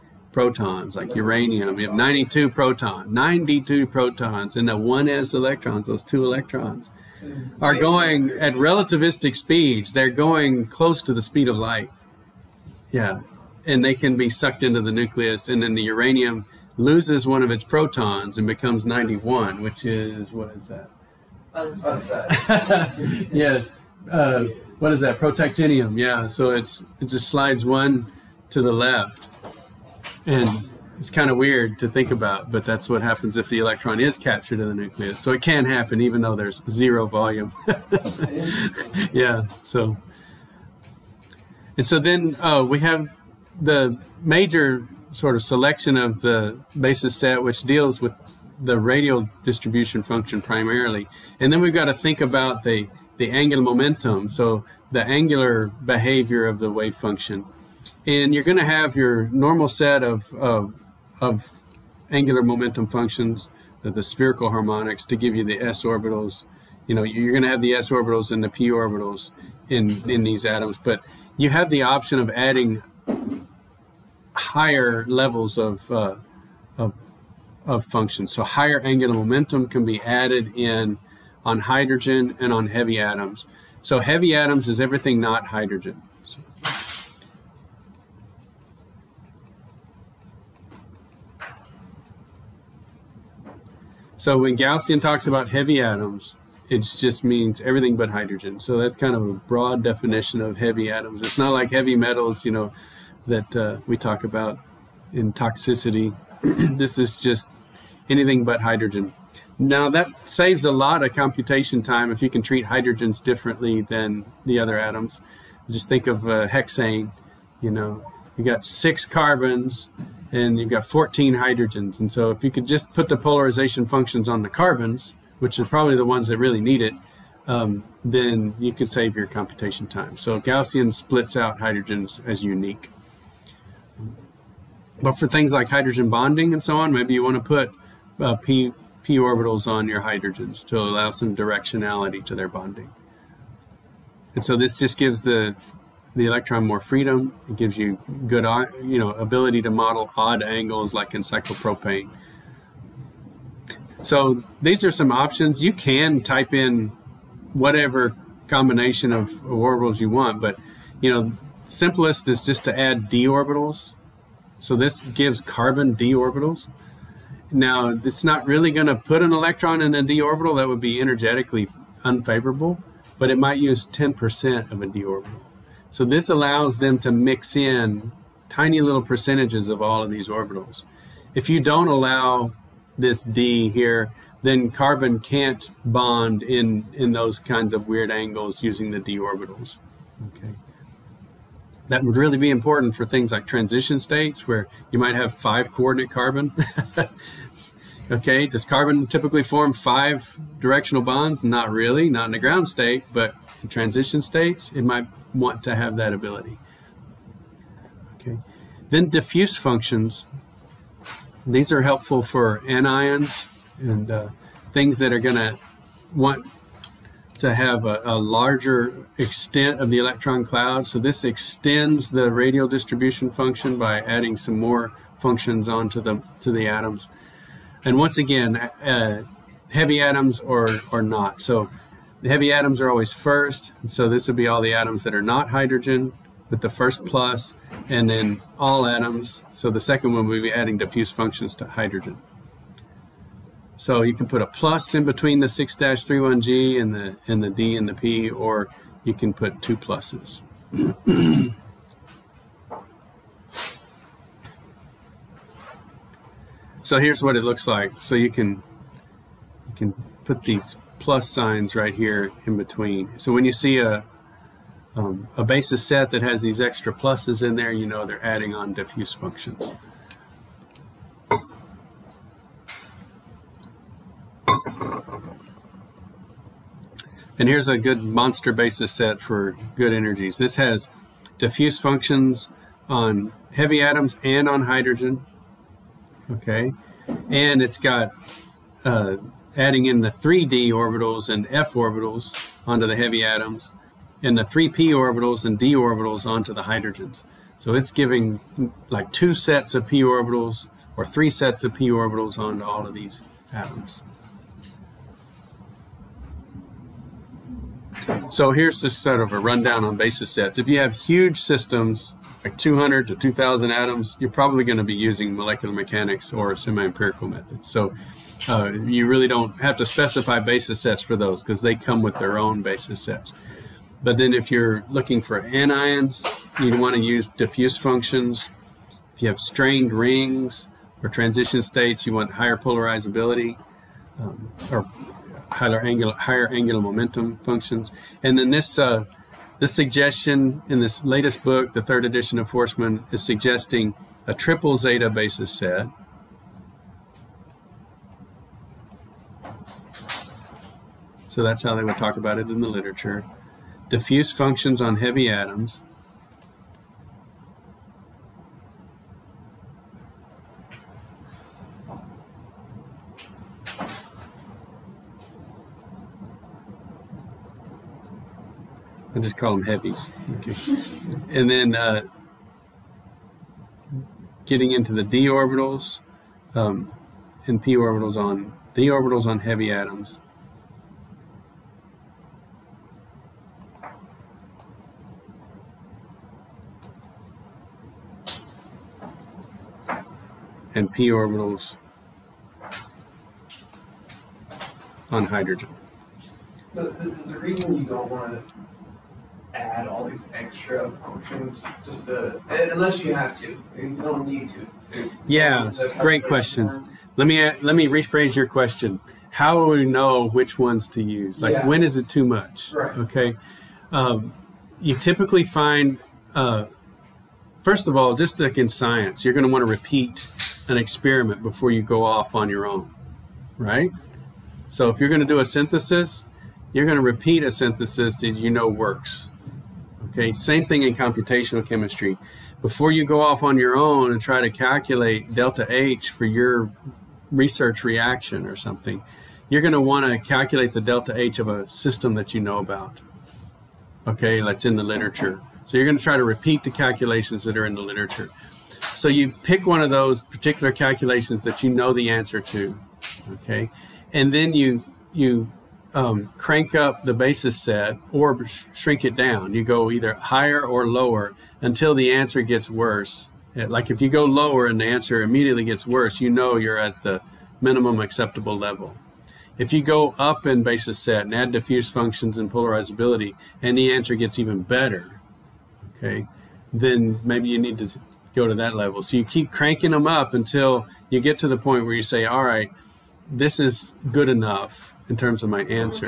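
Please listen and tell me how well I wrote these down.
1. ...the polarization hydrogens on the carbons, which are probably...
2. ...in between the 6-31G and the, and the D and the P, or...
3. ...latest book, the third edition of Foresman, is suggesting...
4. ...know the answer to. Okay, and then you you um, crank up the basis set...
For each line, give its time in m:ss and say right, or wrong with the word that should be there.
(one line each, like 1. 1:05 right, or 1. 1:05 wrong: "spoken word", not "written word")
1. 2:03 wrong: "functions", not "hydrogens"
2. 4:04 right
3. 5:41 right
4. 7:31 right.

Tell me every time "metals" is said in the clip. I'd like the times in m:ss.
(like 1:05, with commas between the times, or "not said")
1:41.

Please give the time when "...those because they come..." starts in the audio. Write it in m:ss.
5:21.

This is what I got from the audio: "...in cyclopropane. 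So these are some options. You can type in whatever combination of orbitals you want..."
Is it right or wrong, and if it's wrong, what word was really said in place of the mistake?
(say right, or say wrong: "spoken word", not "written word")
right.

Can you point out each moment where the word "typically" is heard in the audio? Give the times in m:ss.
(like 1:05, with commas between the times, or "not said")
3:19, 6:54.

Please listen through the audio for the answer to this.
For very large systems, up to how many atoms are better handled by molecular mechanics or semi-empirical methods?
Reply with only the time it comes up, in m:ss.
5:13.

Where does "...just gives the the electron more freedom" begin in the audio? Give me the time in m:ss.
2:24.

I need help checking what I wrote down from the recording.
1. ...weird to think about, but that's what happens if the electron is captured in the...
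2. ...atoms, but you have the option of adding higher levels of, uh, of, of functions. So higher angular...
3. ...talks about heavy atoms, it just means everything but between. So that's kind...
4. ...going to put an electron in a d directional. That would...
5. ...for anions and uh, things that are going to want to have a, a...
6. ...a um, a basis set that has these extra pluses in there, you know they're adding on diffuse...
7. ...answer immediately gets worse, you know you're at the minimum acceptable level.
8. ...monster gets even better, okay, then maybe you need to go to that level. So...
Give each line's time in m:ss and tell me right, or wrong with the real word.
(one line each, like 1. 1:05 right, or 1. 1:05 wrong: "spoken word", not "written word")
1. 0:31 right
2. 1:10 right
3. 1:34 wrong: "hydrogen", not "between"
4. 2:48 wrong: "orbital", not "directional"
5. 3:32 right
6. 4:23 right
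7. 7:44 right
8. 7:53 wrong: "answer", not "monster".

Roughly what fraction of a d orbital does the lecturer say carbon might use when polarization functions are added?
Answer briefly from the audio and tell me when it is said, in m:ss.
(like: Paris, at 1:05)
10%, at 2:53.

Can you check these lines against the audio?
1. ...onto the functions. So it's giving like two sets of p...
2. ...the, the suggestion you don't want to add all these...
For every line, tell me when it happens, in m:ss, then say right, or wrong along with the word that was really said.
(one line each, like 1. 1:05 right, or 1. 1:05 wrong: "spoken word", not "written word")
1. 4:56 wrong: "hydrogens", not "functions"
2. 6:36 wrong: "reason", not "suggestion".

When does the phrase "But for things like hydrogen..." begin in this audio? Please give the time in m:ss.
2:15.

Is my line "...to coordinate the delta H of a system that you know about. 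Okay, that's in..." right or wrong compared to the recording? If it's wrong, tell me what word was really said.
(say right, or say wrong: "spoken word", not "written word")
wrong: "calculate", not "coordinate".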